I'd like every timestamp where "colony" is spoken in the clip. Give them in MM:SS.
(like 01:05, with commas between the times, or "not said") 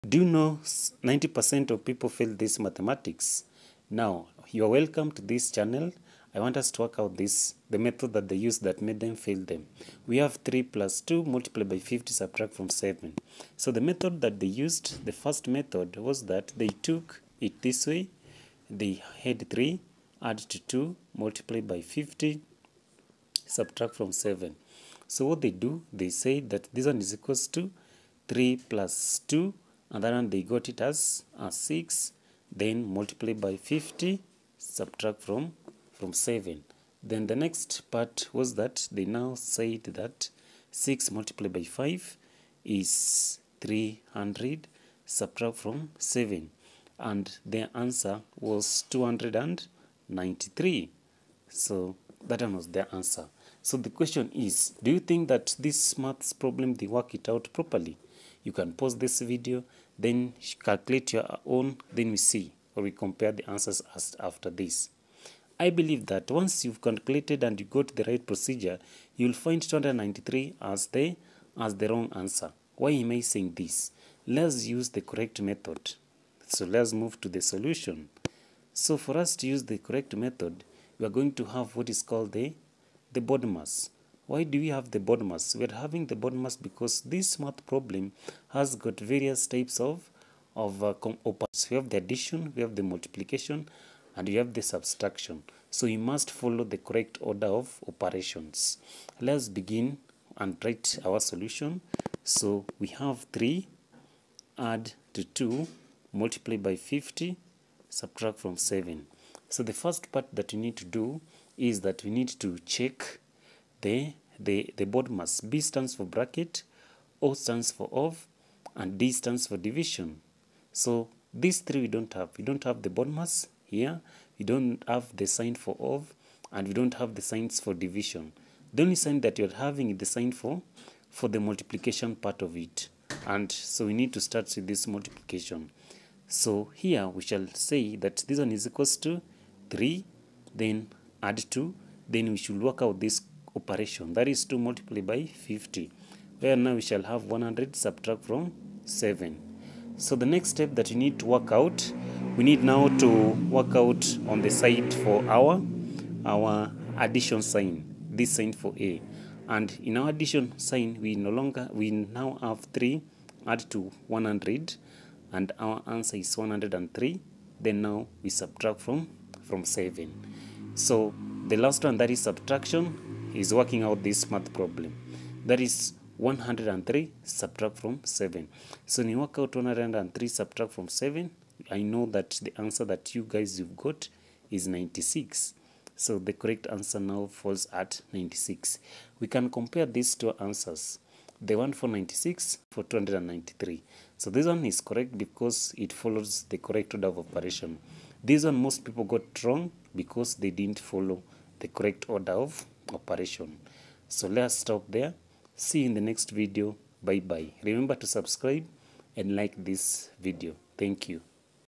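not said.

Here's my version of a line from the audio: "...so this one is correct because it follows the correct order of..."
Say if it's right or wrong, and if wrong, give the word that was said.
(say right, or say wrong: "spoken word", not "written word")
right.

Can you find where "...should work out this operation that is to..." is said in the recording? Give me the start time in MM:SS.
02:22.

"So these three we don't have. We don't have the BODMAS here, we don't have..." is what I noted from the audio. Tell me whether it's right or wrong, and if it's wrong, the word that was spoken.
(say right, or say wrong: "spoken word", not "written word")
right.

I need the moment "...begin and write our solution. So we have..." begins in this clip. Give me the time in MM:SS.
01:39.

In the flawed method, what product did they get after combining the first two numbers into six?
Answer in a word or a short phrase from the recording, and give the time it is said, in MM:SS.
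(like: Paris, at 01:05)
300, at 00:43.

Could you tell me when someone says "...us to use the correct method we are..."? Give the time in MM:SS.
01:19.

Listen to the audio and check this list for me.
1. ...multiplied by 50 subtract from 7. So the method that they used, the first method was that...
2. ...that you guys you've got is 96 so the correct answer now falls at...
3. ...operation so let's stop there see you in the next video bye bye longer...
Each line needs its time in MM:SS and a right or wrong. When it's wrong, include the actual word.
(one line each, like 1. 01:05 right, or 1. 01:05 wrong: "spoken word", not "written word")
1. 00:11 right
2. 03:02 right
3. 03:22 wrong: "remember", not "longer".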